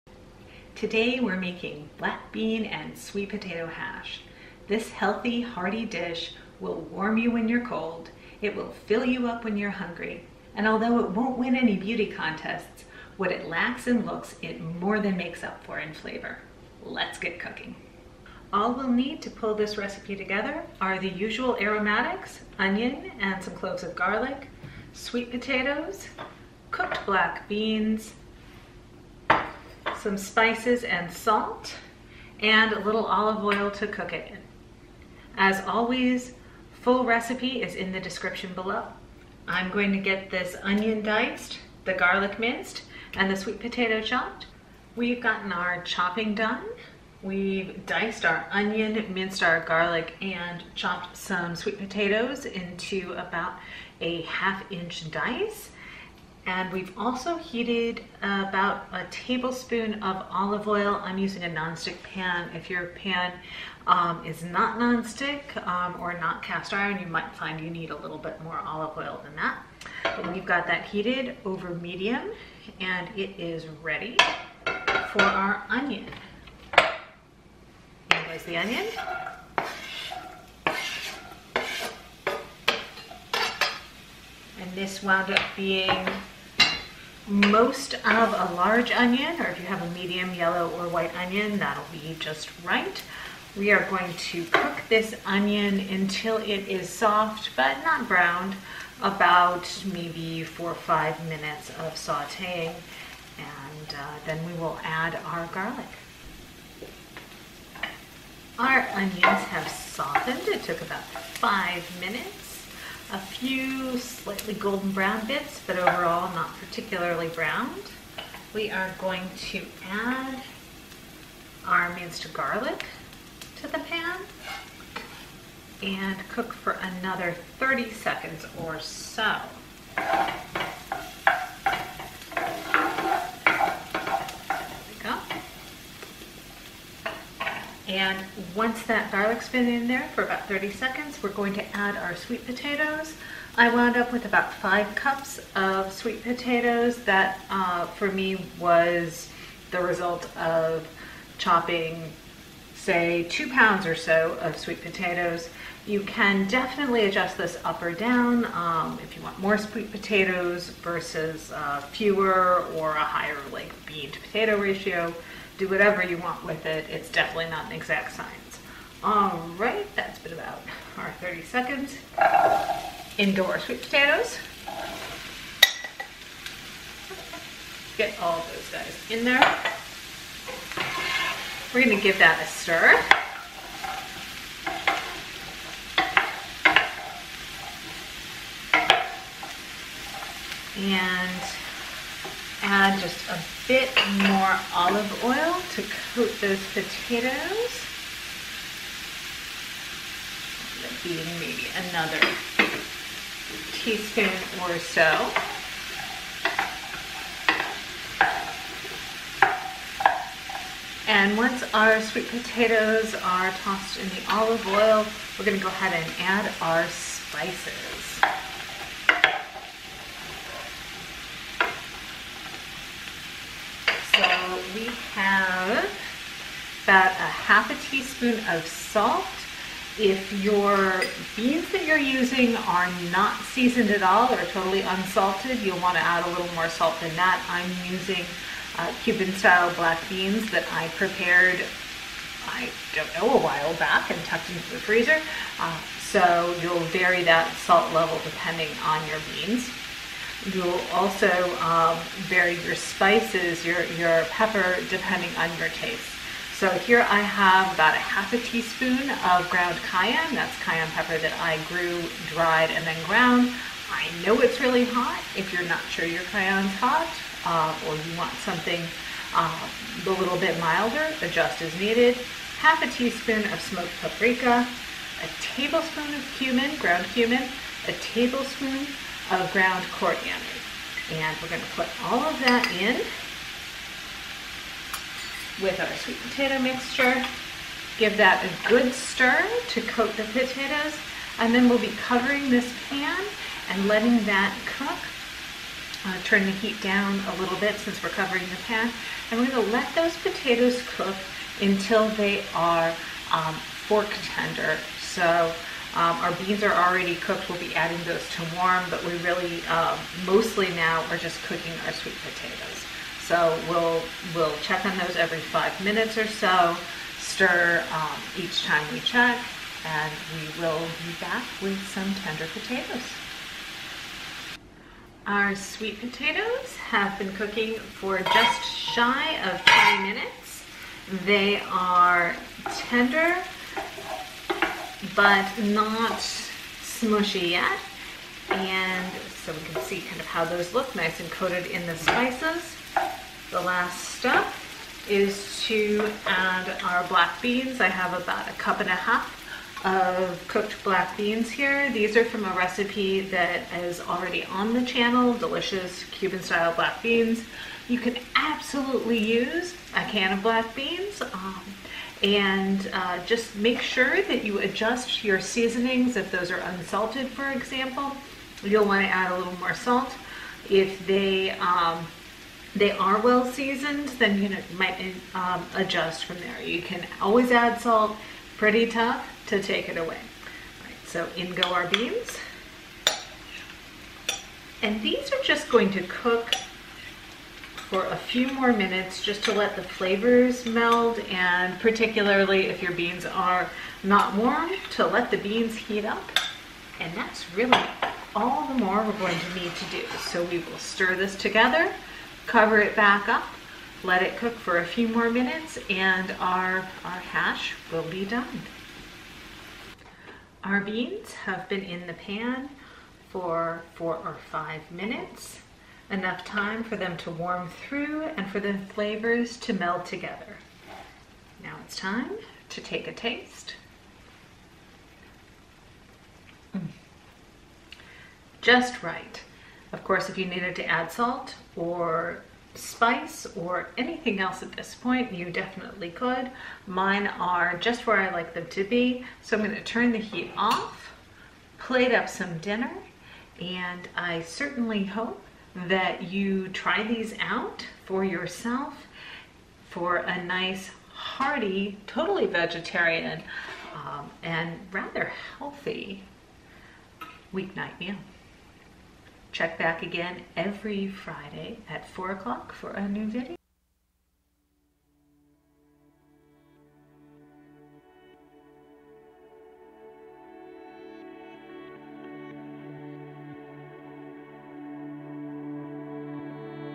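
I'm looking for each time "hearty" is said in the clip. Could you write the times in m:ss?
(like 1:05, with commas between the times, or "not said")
0:05, 7:31.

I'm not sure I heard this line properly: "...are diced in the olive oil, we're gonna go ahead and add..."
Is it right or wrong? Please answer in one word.
wrong.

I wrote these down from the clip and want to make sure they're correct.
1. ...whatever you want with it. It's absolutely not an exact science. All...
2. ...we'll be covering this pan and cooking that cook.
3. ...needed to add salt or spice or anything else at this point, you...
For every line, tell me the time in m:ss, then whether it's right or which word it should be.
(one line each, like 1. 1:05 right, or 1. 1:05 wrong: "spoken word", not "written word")
1. 2:45 wrong: "definitely", not "absolutely"
2. 4:51 wrong: "letting", not "cooking"
3. 7:10 right.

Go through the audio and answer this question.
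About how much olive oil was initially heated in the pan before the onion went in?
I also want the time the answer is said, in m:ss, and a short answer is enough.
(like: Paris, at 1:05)
1 tablespoon, at 0:58.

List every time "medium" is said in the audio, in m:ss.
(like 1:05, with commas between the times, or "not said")
1:11, 1:29.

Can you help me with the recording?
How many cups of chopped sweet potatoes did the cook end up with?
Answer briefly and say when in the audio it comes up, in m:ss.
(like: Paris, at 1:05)
5 cups, at 2:24.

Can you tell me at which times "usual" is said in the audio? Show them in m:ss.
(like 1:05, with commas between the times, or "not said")
0:21.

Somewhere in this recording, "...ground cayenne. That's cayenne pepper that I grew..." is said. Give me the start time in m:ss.
4:19.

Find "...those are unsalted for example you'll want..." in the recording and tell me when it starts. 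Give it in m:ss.
6:06.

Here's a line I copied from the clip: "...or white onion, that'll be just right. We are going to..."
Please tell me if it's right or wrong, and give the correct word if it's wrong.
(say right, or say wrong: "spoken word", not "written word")
right.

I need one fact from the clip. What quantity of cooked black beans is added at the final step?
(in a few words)
1.5 cups.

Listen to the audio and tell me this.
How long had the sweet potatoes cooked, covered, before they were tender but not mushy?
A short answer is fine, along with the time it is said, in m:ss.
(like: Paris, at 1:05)
just under 20 minutes, at 5:28.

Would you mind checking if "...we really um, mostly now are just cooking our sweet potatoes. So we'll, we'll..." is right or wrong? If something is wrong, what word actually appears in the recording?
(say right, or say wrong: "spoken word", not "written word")
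right.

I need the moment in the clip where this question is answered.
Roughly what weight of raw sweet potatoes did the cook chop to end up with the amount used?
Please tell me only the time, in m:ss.
2:33.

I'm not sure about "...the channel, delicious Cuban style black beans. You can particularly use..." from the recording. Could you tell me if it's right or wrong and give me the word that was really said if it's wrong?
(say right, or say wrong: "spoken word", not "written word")
wrong: "absolutely", not "particularly".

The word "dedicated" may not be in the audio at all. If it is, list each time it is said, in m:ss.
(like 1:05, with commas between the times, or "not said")
not said.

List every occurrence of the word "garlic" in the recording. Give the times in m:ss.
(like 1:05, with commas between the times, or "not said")
0:23, 0:41, 0:49, 1:45, 2:02, 2:19.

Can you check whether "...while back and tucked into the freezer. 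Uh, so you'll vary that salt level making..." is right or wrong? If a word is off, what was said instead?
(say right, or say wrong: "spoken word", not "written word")
wrong: "depending", not "making".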